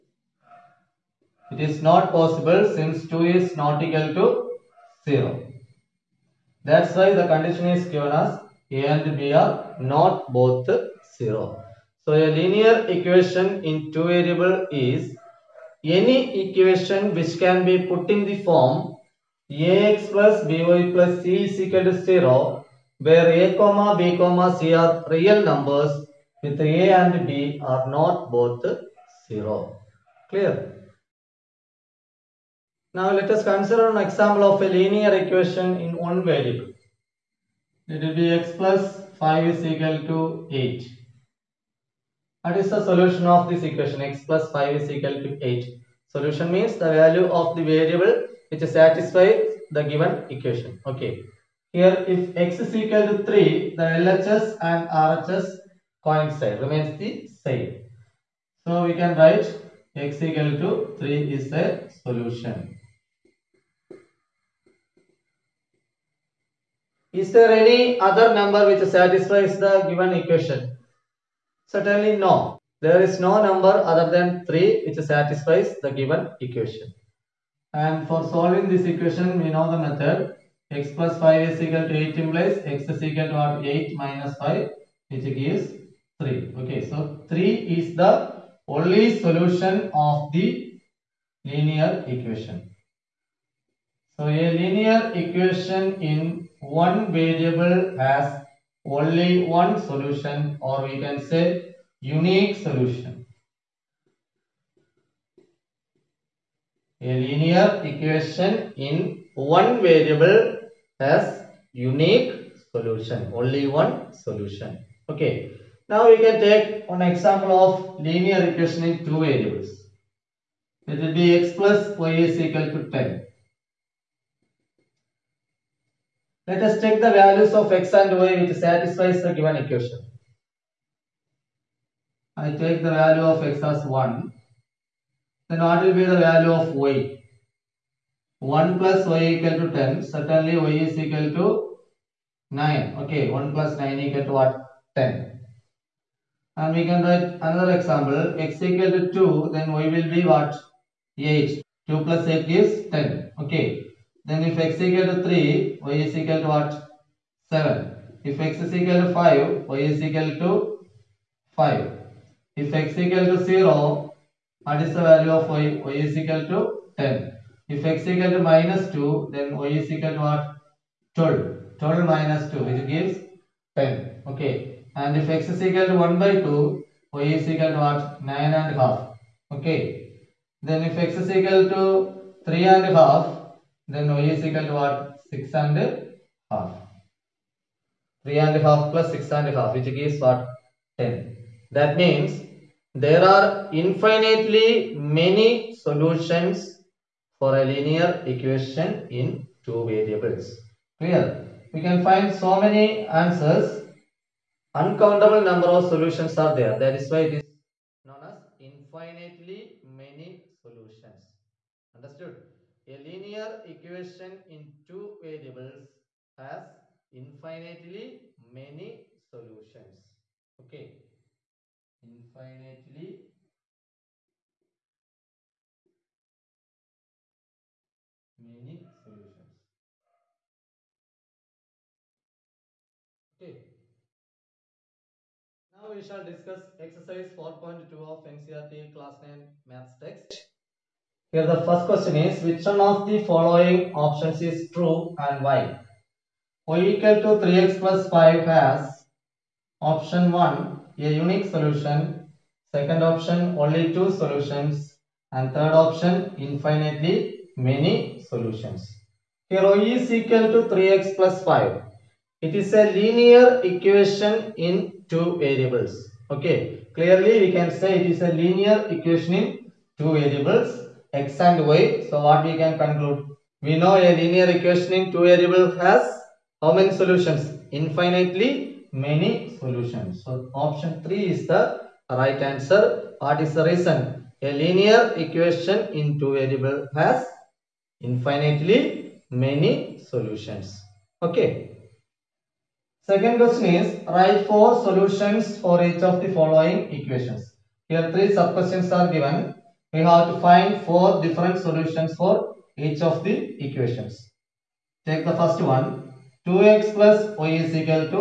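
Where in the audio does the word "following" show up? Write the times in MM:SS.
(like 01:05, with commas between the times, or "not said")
04:03, 04:56.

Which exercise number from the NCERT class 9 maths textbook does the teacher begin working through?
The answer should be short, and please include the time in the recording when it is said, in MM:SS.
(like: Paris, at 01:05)
4.2, at 03:57.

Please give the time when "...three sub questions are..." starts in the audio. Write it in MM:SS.
04:58.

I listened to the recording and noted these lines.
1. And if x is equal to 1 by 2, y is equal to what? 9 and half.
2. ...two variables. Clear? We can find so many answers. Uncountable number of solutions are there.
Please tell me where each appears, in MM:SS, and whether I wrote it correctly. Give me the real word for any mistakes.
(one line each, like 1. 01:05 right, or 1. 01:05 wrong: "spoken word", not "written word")
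1. 02:54 right
2. 03:19 right.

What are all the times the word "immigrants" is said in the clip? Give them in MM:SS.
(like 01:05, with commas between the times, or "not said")
not said.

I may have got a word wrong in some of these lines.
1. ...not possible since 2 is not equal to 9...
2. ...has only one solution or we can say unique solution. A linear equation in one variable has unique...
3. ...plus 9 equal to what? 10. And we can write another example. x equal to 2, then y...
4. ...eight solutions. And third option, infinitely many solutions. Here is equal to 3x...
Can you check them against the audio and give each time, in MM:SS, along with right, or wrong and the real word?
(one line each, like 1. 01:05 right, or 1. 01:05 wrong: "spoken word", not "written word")
1. 00:01 wrong: "0", not "9"
2. 01:37 right
3. 02:23 right
4. 04:13 wrong: "two", not "eight".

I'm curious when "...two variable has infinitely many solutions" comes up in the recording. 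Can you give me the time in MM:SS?
04:46.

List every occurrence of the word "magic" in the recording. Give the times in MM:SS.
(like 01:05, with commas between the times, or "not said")
not said.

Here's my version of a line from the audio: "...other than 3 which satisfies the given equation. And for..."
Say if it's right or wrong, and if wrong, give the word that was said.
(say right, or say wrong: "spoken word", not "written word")
right.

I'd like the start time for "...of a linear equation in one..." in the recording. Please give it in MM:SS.
00:34.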